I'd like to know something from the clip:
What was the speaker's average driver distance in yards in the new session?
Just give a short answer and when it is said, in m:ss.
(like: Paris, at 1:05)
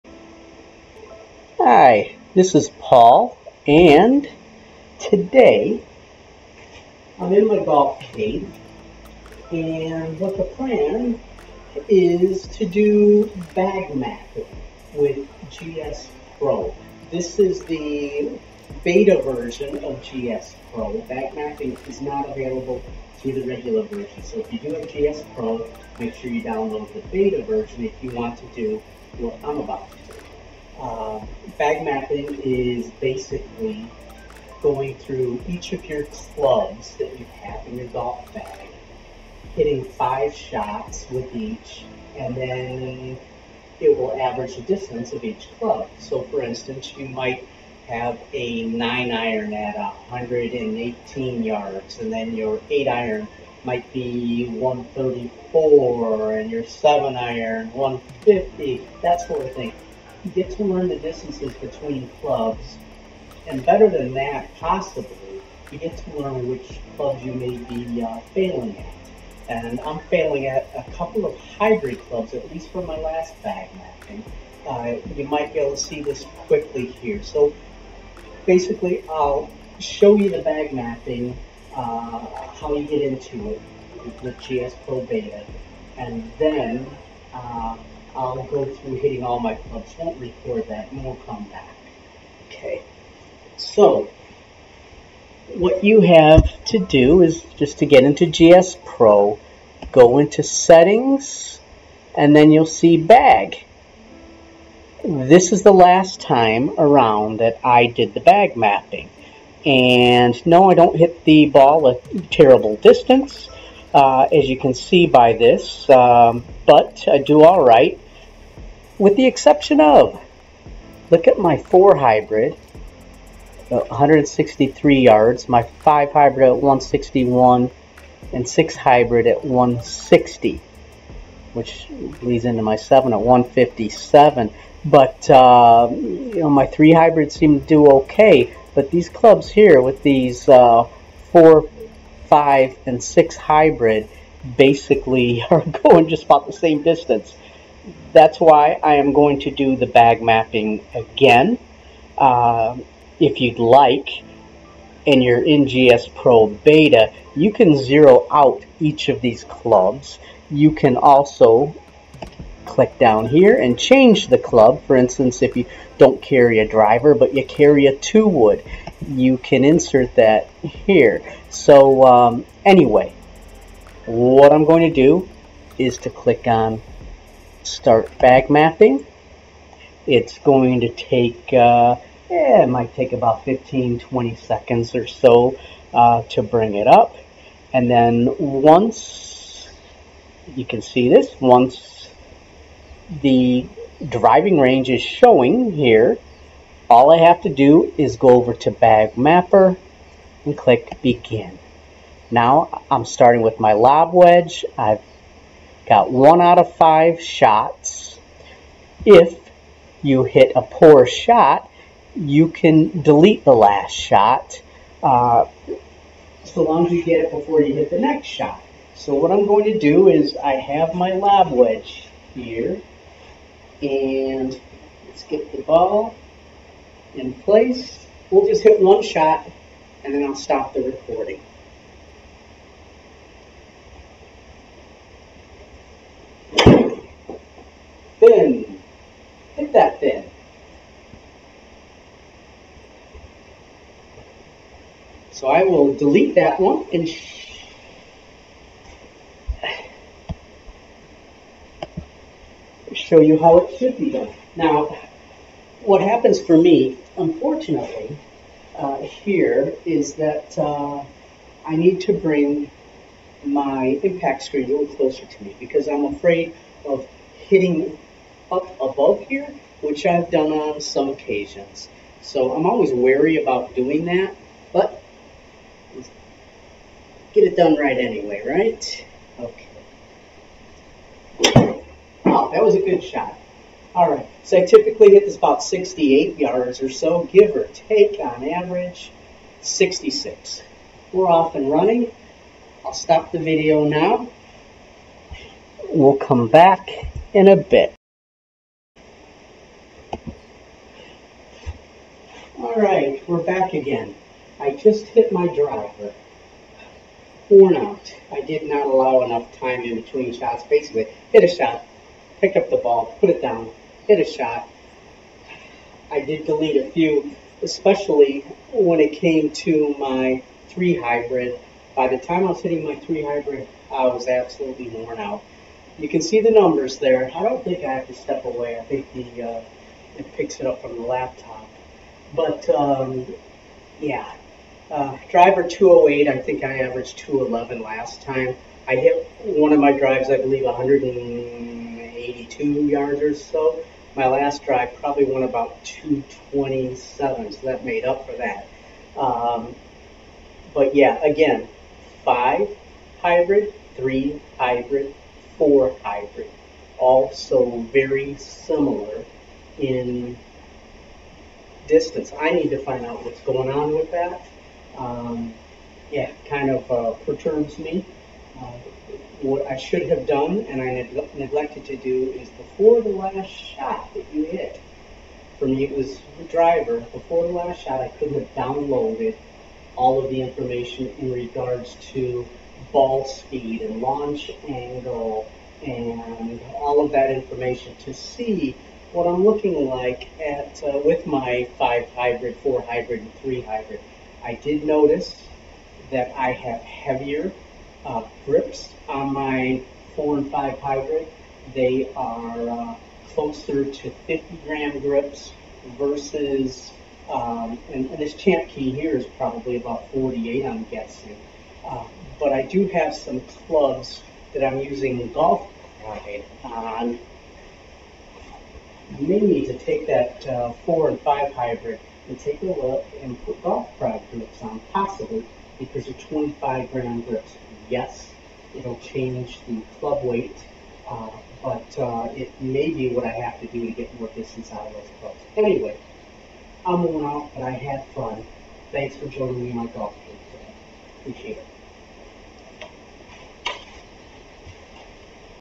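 208, at 5:35.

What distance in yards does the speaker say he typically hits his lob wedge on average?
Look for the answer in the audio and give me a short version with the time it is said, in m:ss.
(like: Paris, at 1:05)
66, at 4:49.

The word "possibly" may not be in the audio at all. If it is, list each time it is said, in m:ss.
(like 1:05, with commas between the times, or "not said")
1:04, 7:04.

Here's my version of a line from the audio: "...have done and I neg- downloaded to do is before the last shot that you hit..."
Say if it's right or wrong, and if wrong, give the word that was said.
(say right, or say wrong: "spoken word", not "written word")
wrong: "neglected", not "downloaded".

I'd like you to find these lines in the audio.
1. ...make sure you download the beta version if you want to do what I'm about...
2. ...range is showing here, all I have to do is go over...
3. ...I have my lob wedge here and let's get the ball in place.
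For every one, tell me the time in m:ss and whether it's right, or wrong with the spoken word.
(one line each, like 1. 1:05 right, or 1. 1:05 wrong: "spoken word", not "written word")
1. 0:25 right
2. 3:14 right
3. 3:40 right.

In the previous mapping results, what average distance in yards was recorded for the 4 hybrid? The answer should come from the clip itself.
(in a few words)
163 yards.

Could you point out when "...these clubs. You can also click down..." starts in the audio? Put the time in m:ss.
2:39.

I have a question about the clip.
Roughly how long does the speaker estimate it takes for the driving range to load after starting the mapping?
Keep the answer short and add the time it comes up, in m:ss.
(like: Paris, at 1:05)
15 to 20 seconds, at 3:03.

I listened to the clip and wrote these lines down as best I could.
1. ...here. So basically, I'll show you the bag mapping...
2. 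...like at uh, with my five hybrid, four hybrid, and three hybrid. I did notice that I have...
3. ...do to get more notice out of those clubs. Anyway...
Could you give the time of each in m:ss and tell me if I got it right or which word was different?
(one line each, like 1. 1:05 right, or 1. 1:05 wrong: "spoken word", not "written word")
1. 1:16 right
2. 6:29 right
3. 7:13 wrong: "distance", not "notice".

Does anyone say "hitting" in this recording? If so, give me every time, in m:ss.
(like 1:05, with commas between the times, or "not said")
0:39, 1:28, 4:27, 5:22.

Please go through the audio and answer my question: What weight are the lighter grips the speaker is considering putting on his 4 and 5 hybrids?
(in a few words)
25 grams.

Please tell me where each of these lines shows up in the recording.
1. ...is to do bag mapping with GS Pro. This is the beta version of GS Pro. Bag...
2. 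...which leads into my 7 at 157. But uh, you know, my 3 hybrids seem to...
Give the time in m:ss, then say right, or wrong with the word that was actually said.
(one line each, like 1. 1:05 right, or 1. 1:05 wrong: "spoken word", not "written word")
1. 0:11 right
2. 2:11 right.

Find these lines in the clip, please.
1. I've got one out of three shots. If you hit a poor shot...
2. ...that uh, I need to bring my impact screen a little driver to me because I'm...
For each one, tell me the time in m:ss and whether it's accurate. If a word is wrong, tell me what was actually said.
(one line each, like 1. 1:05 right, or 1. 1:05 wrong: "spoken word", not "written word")
1. 3:24 wrong: "five", not "three"
2. 4:20 wrong: "closer", not "driver".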